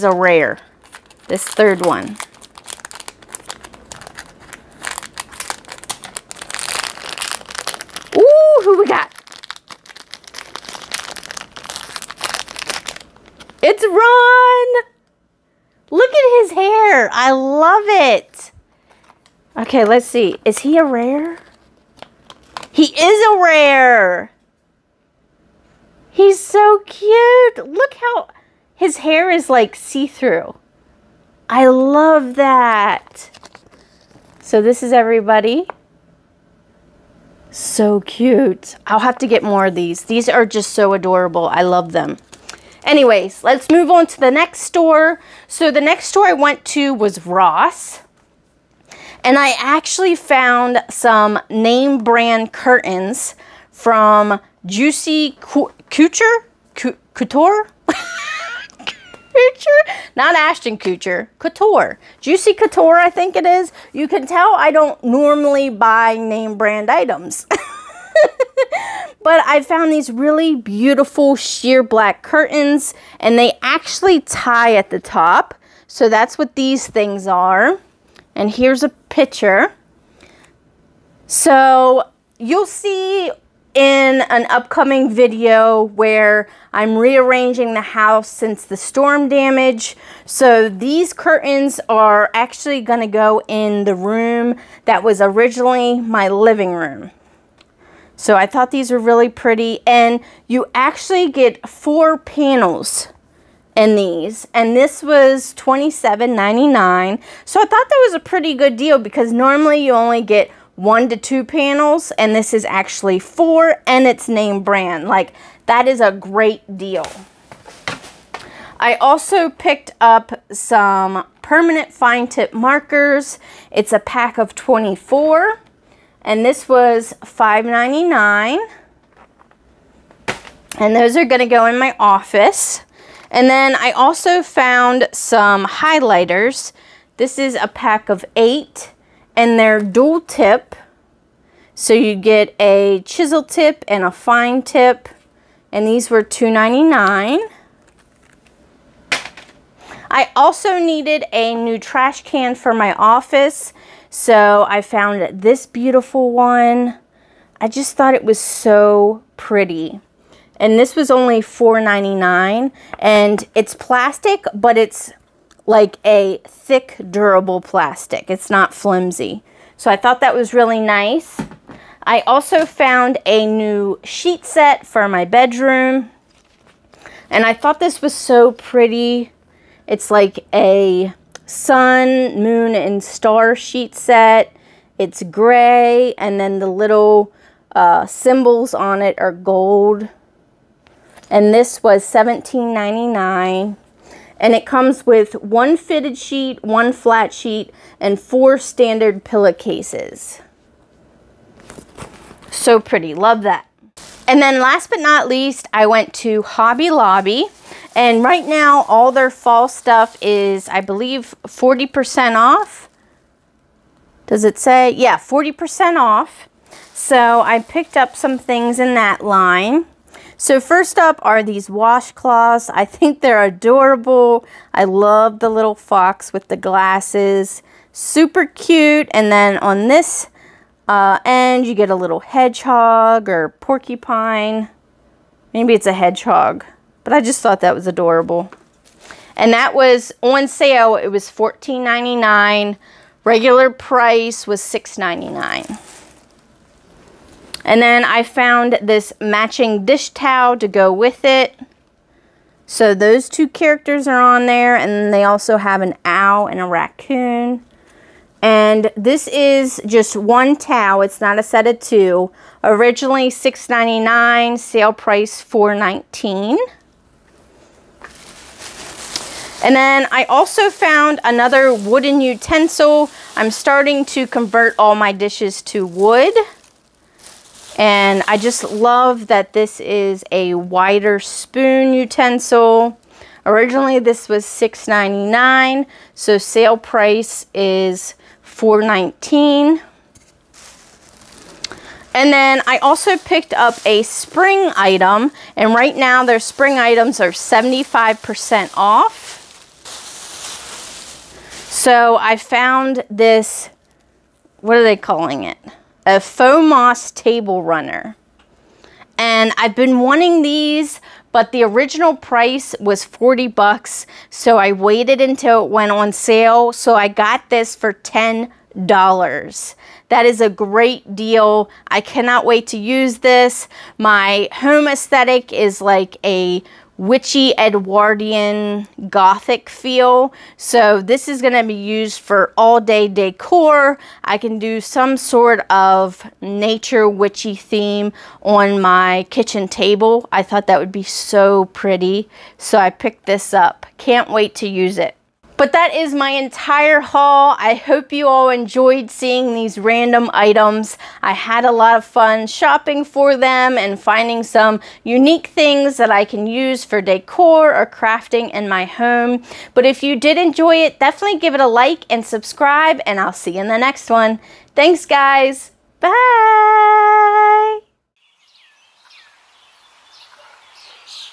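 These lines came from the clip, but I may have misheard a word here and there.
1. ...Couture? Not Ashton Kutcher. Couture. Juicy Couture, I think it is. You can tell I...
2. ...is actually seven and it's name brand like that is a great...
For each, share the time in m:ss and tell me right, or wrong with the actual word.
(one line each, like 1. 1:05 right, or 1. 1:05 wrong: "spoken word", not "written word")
1. 0:56 right
2. 1:52 wrong: "four", not "seven".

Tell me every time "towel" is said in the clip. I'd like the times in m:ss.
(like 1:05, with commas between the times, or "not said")
4:10, 4:20.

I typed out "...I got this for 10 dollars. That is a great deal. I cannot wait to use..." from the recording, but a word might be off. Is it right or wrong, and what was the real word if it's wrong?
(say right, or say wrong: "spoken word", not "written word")
right.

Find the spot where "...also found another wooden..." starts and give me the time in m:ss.
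4:30.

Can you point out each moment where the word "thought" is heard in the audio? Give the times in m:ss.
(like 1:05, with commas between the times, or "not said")
1:38, 1:47, 2:37, 2:49, 2:57, 3:57, 5:40.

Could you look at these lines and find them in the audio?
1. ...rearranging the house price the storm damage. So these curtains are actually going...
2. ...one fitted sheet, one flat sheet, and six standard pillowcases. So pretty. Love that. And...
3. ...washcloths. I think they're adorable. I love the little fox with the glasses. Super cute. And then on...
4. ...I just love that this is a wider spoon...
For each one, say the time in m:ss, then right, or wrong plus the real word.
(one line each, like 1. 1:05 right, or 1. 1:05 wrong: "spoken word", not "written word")
1. 1:26 wrong: "since", not "price"
2. 3:15 wrong: "four", not "six"
3. 3:41 right
4. 4:38 right.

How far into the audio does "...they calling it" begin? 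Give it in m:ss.
5:04.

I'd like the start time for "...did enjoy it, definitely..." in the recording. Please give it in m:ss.
6:00.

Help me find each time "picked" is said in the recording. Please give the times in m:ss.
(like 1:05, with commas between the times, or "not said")
1:59, 3:37, 4:53, 5:42.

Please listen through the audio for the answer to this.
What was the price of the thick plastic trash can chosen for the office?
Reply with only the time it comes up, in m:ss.
2:41.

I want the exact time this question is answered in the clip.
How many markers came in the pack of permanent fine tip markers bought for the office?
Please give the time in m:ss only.
2:04.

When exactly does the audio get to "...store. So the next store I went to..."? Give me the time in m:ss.
0:44.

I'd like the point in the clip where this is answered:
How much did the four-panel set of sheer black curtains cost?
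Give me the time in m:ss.
1:45.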